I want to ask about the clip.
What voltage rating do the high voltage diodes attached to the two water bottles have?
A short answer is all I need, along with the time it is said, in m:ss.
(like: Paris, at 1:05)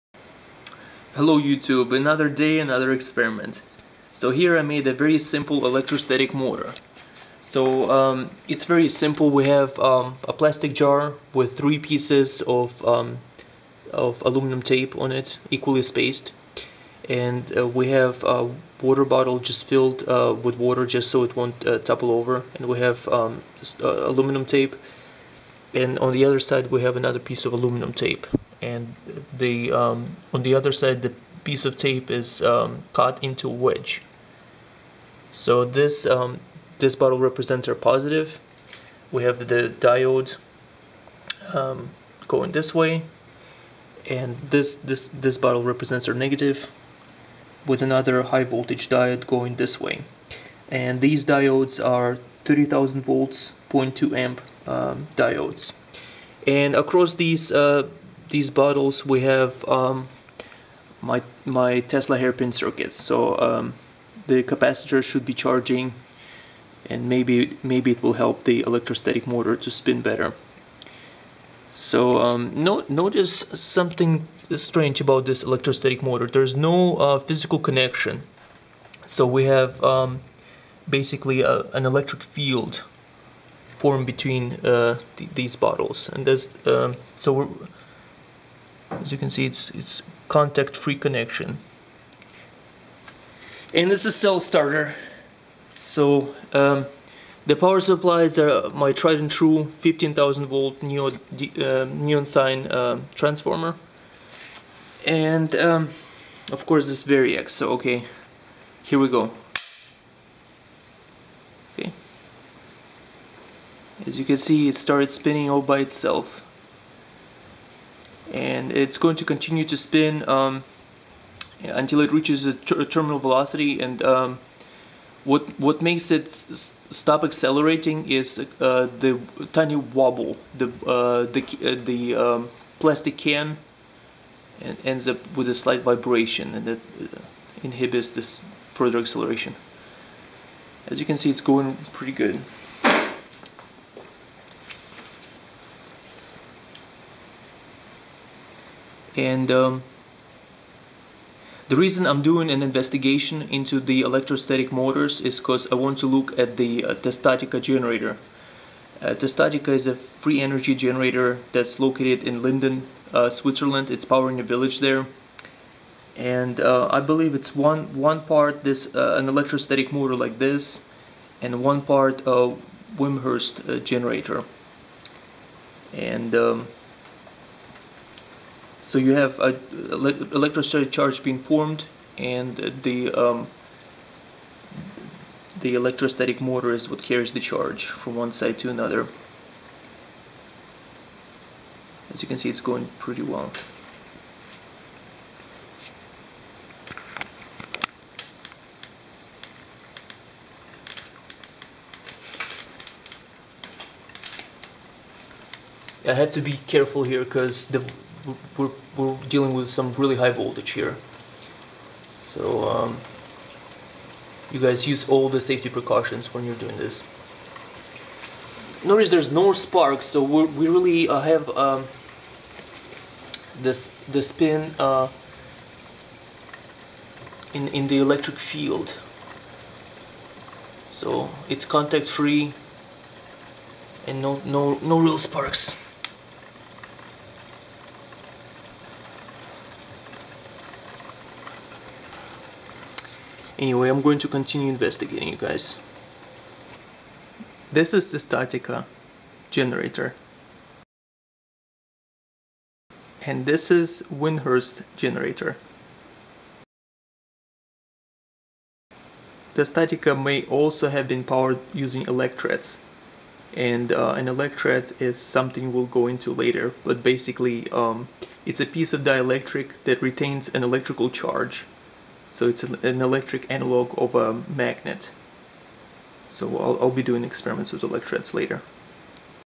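30,000 volts, at 0:52.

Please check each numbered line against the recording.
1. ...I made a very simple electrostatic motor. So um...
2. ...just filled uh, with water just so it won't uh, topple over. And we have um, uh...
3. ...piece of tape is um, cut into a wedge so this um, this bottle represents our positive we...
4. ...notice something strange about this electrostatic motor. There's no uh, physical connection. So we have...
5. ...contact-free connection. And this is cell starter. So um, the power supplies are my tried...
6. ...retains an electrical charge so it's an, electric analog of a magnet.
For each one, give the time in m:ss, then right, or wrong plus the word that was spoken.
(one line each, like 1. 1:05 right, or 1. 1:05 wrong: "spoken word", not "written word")
1. 0:04 right
2. 0:19 right
3. 0:31 right
4. 1:12 right
5. 1:30 right
6. 4:30 right.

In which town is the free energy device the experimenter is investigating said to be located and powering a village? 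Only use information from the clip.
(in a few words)
Linden.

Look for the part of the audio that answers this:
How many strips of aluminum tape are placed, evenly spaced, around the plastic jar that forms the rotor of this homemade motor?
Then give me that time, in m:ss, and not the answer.
0:11.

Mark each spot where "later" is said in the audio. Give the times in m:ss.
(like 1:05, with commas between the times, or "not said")
4:26, 4:38.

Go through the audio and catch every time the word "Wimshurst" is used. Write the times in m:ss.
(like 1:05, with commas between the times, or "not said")
2:52, 4:14.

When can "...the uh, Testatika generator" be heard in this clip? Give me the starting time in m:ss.
2:36.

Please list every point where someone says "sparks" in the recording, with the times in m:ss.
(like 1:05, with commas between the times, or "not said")
3:39, 3:55.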